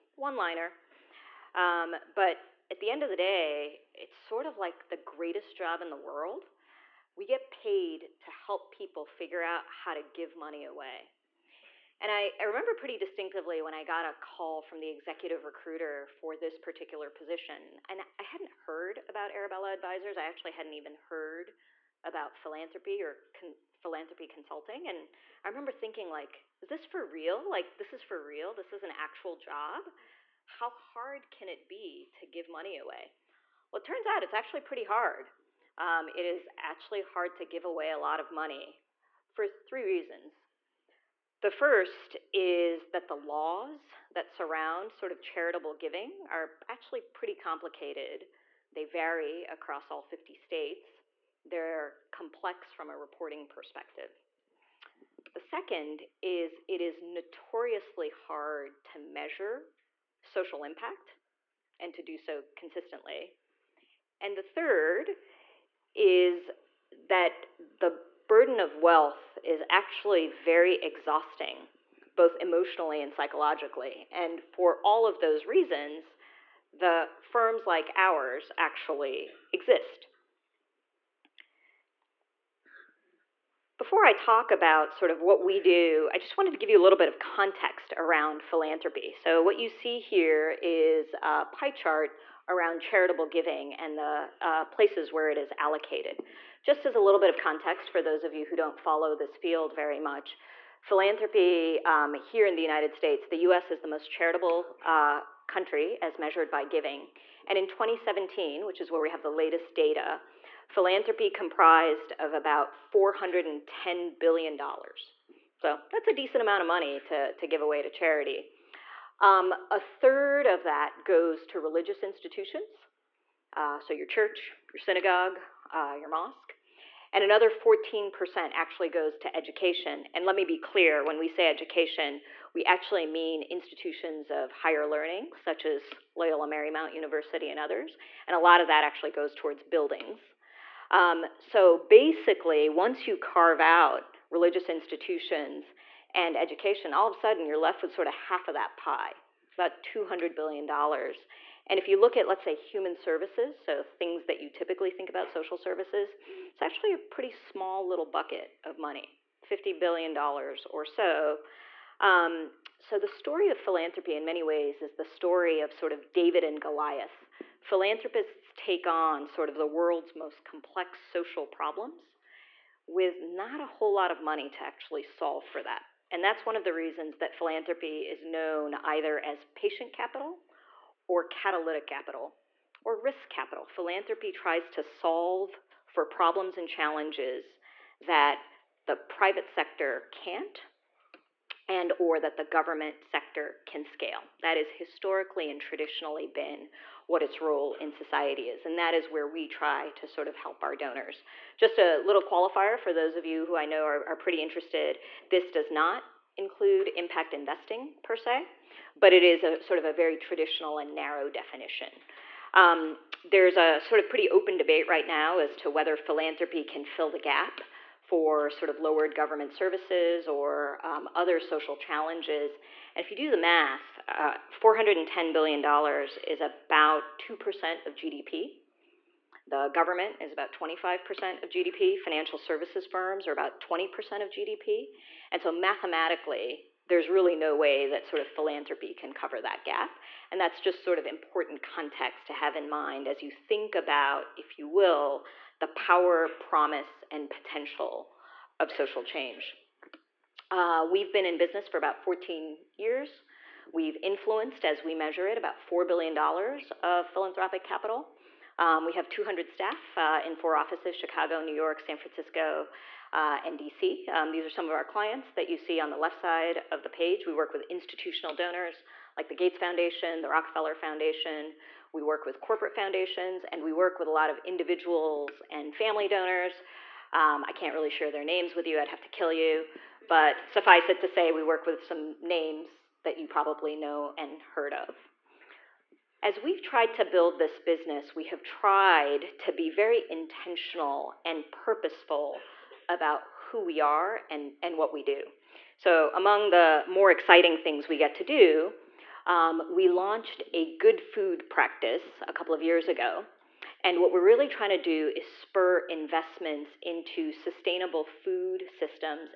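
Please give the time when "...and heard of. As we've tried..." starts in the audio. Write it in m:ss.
4:44.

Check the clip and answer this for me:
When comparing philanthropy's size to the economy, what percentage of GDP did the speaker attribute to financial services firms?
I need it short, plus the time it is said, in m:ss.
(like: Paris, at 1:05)
20%, at 3:53.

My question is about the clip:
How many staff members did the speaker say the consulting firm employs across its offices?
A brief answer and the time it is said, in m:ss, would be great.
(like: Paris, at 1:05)
200, at 4:19.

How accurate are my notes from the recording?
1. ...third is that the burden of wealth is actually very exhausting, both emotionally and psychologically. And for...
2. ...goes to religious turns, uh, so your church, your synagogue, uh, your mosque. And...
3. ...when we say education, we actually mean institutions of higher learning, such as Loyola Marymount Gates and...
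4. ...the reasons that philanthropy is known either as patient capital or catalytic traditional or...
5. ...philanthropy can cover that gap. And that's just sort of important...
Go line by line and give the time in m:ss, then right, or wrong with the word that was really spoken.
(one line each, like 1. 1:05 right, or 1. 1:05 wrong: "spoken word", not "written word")
1. 1:04 right
2. 2:01 wrong: "institutions", not "turns"
3. 2:11 wrong: "University", not "Gates"
4. 2:56 wrong: "capital", not "traditional"
5. 3:58 right.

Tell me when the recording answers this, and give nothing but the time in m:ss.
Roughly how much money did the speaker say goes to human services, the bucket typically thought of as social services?
2:39.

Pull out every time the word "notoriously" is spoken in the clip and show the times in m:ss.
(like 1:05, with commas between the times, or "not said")
0:57.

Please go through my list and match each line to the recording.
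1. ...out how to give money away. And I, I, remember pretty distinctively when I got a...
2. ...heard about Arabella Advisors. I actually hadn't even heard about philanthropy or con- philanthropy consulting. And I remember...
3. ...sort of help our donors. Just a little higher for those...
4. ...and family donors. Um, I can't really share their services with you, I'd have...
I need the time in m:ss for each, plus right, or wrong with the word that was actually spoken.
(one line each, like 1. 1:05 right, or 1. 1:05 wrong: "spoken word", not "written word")
1. 0:09 right
2. 0:18 right
3. 3:20 wrong: "qualifier", not "higher"
4. 4:35 wrong: "names", not "services".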